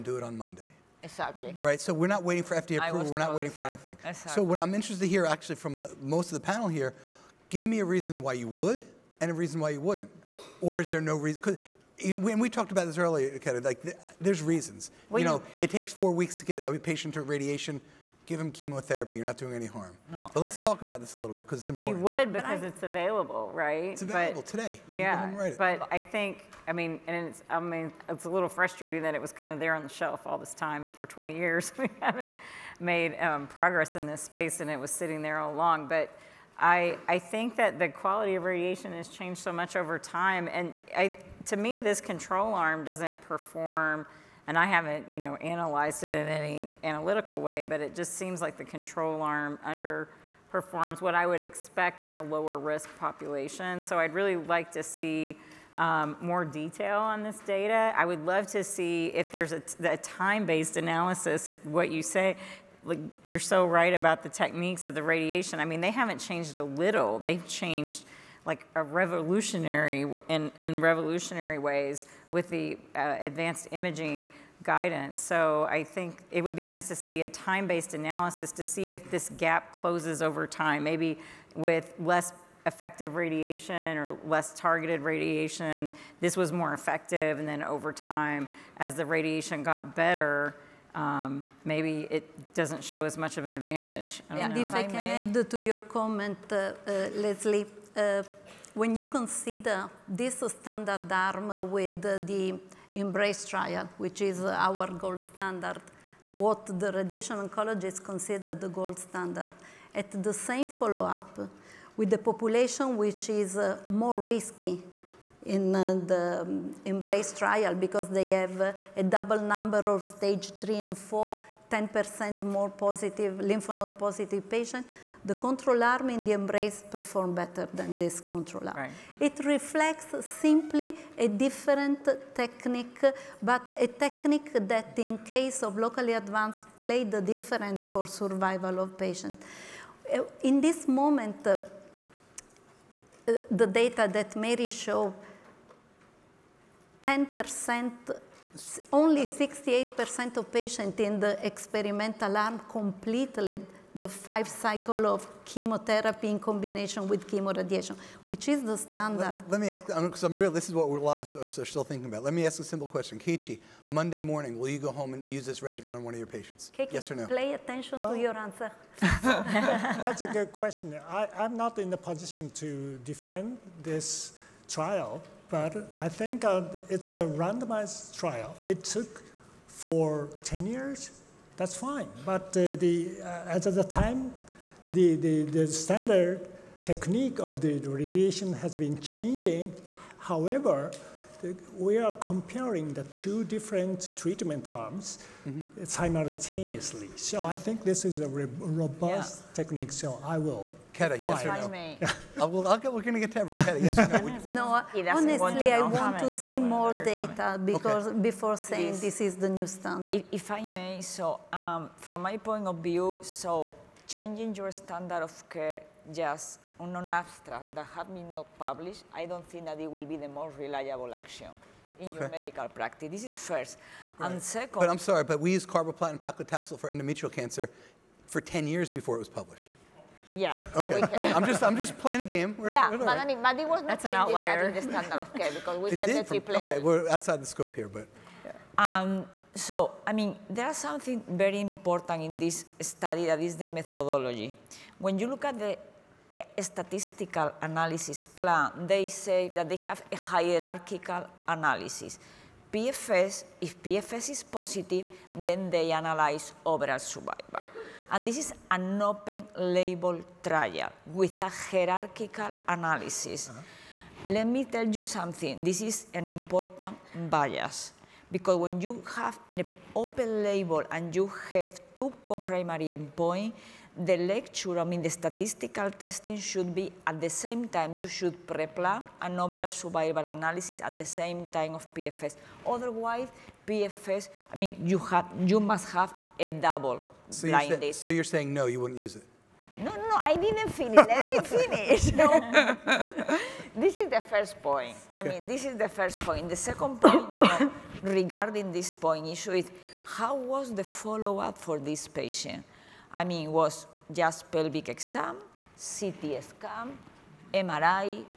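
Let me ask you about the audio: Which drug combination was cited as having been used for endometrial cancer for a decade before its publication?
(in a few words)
carboplatin paclitaxel.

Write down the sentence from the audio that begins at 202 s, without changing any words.
I'll, I'll get, we're going to get to everyone.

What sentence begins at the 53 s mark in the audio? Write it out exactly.
So I'd really like to see um, more detail on this data.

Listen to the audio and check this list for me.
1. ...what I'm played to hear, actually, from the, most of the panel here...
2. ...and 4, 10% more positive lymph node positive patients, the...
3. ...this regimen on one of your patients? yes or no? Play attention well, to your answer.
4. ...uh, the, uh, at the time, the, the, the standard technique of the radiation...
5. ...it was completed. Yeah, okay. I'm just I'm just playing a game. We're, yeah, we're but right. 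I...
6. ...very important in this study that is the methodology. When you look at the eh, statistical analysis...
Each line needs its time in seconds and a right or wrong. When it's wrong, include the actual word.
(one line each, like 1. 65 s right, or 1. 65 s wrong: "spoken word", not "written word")
1. 4 s wrong: "interested", not "played"
2. 120 s right
3. 165 s right
4. 182 s right
5. 229 s wrong: "published", not "completed"
6. 241 s right.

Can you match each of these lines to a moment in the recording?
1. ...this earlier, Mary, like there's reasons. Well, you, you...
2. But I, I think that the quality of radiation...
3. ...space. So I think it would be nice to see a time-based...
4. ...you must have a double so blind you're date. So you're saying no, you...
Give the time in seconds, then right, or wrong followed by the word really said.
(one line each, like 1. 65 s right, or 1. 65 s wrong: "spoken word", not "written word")
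1. 12 s wrong: "Kelly", not "Mary"
2. 35 s right
3. 74 s wrong: "guidance", not "space"
4. 285 s right.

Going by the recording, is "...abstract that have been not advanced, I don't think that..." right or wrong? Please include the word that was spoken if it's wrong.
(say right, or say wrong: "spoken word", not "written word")
wrong: "published", not "advanced".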